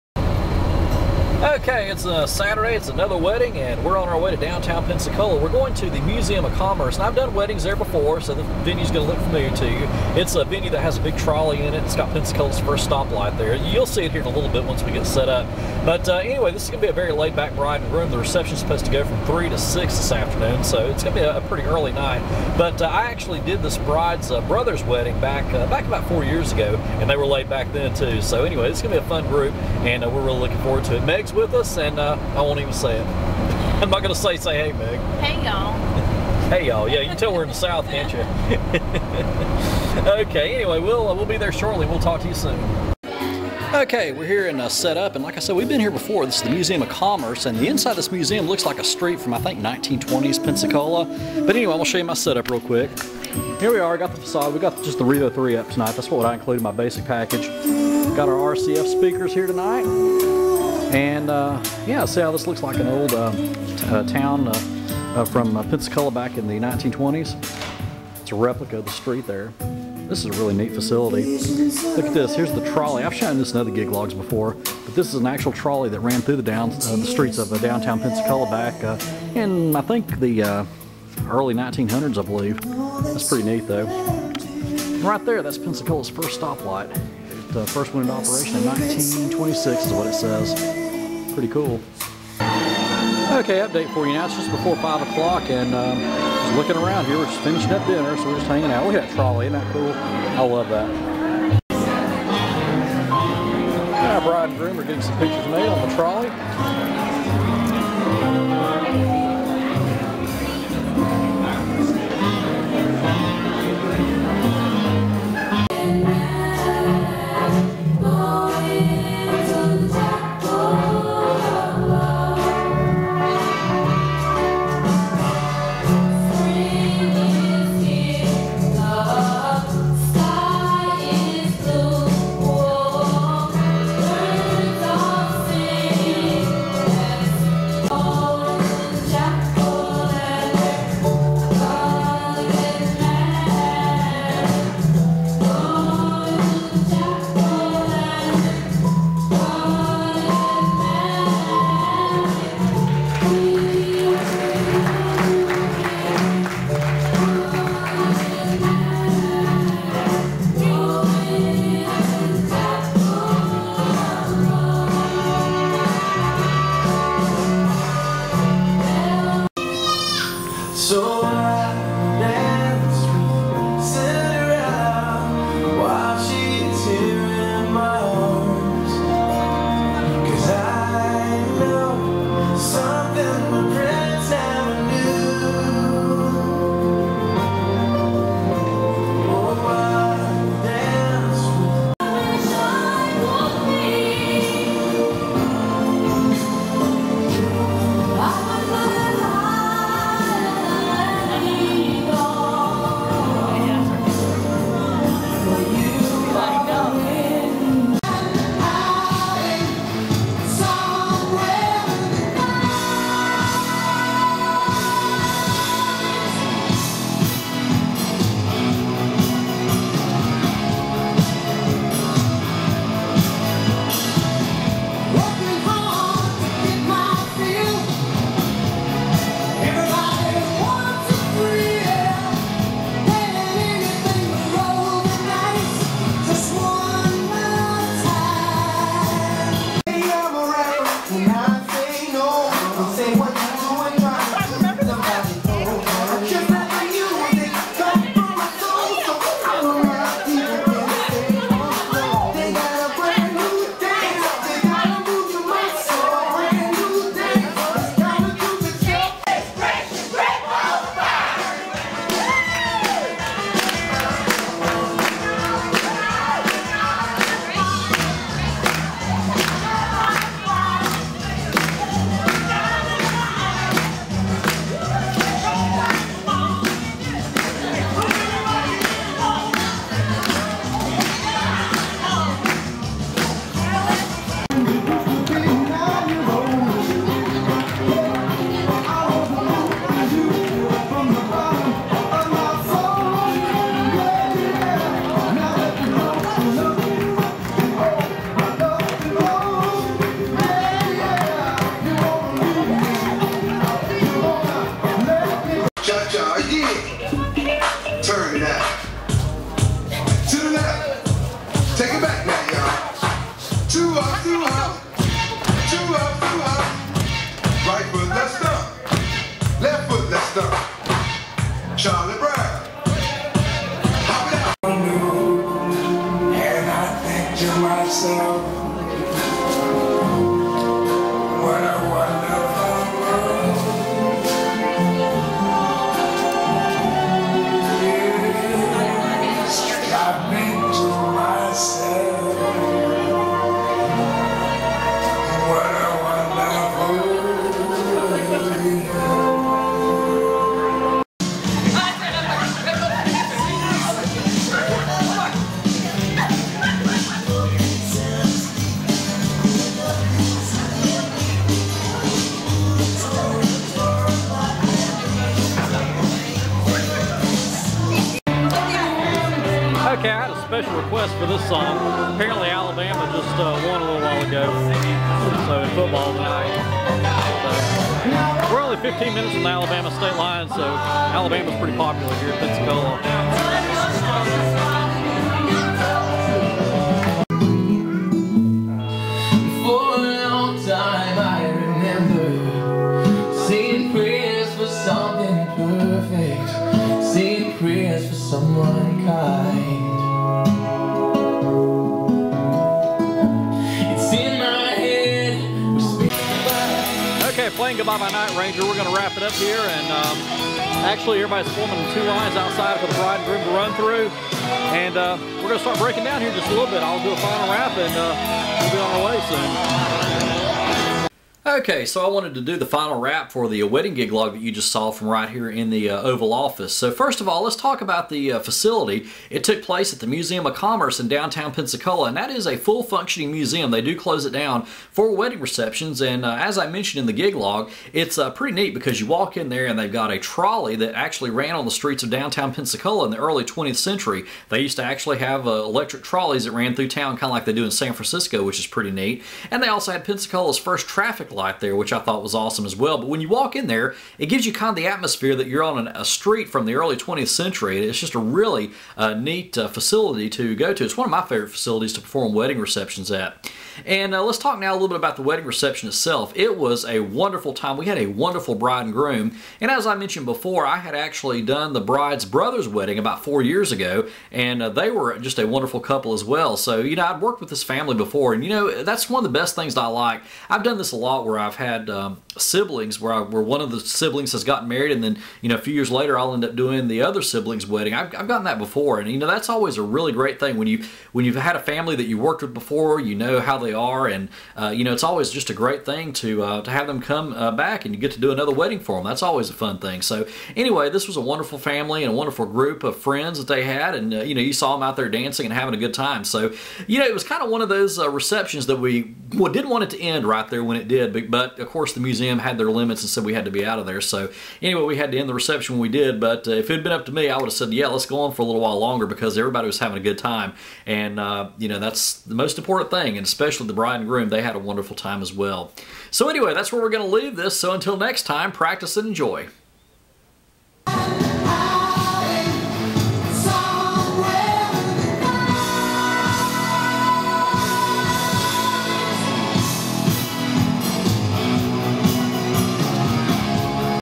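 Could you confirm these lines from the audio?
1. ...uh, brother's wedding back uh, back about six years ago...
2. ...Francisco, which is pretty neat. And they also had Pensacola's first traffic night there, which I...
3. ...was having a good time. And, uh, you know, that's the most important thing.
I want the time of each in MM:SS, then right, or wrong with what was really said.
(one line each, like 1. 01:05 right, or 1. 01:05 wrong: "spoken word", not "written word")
1. 00:24 wrong: "four", not "six"
2. 07:27 wrong: "light", not "night"
3. 08:39 right.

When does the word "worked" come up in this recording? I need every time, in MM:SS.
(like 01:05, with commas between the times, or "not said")
07:57, 08:12.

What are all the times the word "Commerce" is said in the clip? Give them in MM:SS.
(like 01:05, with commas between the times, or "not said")
00:06, 00:46, 07:10.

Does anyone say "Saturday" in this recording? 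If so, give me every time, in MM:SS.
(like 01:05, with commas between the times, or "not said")
00:02.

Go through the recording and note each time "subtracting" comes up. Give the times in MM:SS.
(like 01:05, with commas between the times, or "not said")
not said.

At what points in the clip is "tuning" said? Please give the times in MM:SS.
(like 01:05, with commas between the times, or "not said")
not said.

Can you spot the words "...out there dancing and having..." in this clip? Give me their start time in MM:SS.
08:24.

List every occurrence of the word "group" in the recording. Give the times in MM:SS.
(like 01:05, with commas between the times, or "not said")
00:29, 08:22.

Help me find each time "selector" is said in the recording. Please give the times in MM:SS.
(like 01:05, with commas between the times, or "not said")
not said.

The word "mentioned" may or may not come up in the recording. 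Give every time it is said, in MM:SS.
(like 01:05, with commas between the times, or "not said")
07:16, 07:49.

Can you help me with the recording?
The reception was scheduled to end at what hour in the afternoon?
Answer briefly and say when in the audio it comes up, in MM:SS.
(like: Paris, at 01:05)
6, at 00:19.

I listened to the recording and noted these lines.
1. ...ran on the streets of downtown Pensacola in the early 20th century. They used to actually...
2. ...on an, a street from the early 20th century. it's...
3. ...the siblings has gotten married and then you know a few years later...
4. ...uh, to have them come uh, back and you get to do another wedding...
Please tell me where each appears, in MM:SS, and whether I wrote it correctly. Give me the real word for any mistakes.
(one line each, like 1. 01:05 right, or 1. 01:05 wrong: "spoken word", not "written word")
1. 07:21 right
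2. 07:35 right
3. 08:03 right
4. 08:16 right.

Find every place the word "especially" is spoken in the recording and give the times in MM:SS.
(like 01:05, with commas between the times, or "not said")
08:43.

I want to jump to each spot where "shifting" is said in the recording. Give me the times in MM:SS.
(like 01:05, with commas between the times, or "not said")
not said.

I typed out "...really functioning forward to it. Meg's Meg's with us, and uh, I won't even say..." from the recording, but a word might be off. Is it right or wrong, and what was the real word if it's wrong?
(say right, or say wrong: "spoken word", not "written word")
wrong: "looking", not "functioning".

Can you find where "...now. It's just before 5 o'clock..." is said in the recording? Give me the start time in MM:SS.
01:34.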